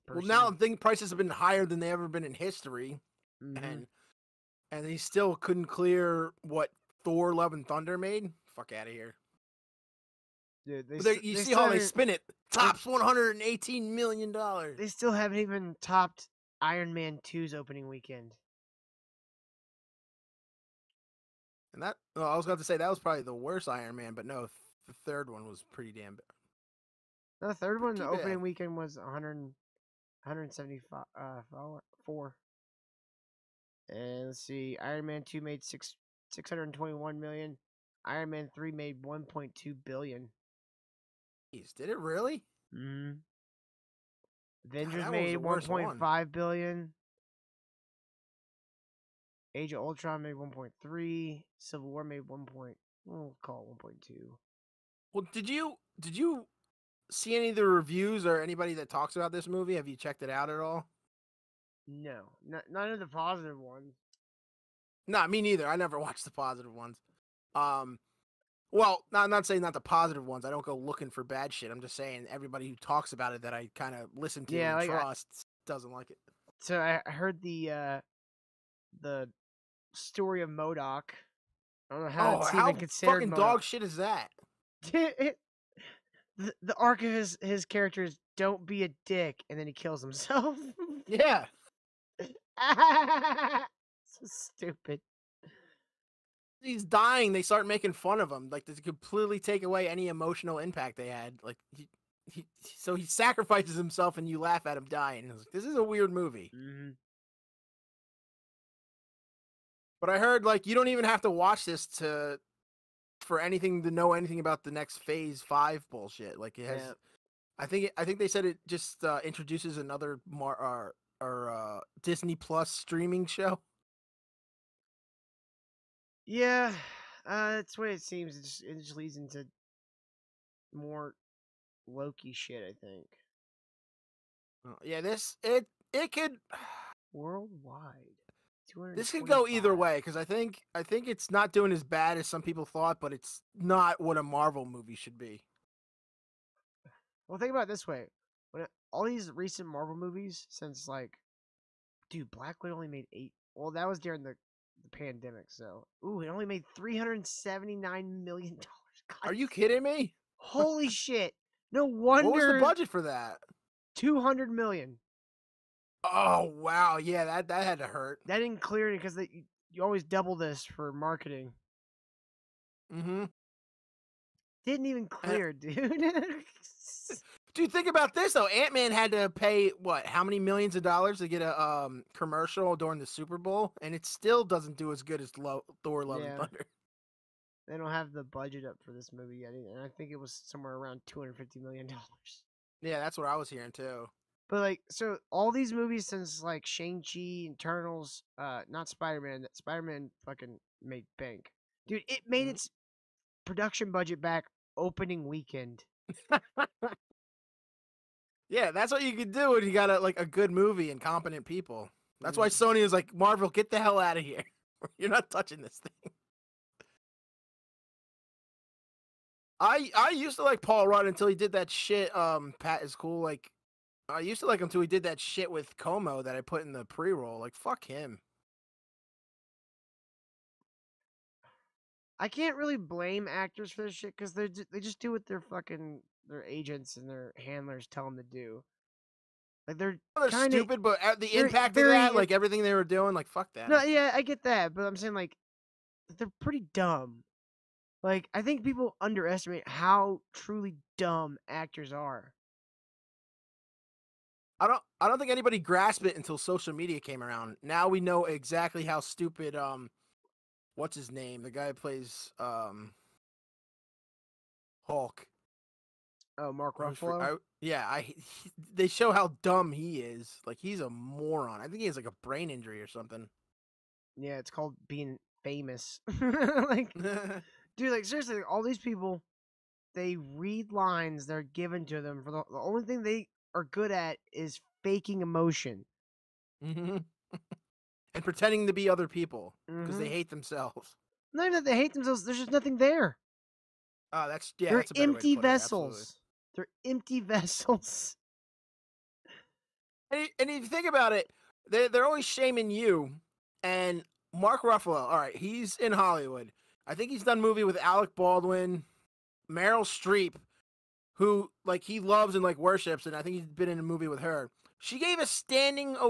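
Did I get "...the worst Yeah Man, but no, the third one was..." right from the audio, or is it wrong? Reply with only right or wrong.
wrong.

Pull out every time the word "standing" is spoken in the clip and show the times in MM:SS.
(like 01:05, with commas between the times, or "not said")
05:15.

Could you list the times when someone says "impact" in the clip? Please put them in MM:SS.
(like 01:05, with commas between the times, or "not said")
01:40, 04:01.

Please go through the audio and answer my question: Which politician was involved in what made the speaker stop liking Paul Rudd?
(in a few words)
Cuomo.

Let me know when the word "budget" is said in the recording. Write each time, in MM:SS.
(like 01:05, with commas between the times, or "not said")
02:42, 03:08, 03:23.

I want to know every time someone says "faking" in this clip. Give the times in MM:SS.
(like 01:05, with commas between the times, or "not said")
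04:44.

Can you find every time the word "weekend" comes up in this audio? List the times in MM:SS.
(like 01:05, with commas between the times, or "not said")
00:17, 00:28, 03:25.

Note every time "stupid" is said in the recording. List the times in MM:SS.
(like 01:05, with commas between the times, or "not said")
01:34, 04:00, 04:19.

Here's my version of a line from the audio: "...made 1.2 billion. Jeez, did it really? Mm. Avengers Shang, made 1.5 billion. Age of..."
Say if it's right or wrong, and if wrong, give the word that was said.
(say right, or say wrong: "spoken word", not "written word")
wrong: "God", not "Shang".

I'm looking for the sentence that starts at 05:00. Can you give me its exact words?
And, and if you think about it, they're, they're always shaming you and Mark Ruffalo.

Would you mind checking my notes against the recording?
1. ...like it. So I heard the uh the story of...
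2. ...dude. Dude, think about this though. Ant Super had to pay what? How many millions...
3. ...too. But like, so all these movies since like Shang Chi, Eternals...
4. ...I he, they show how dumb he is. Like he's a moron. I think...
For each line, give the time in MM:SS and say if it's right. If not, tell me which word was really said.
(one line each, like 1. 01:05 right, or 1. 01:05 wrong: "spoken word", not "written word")
1. 01:15 right
2. 02:55 wrong: "Man", not "Super"
3. 03:13 right
4. 04:27 right.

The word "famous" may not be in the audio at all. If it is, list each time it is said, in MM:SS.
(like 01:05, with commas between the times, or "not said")
04:35.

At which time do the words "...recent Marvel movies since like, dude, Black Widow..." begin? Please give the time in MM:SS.
02:29.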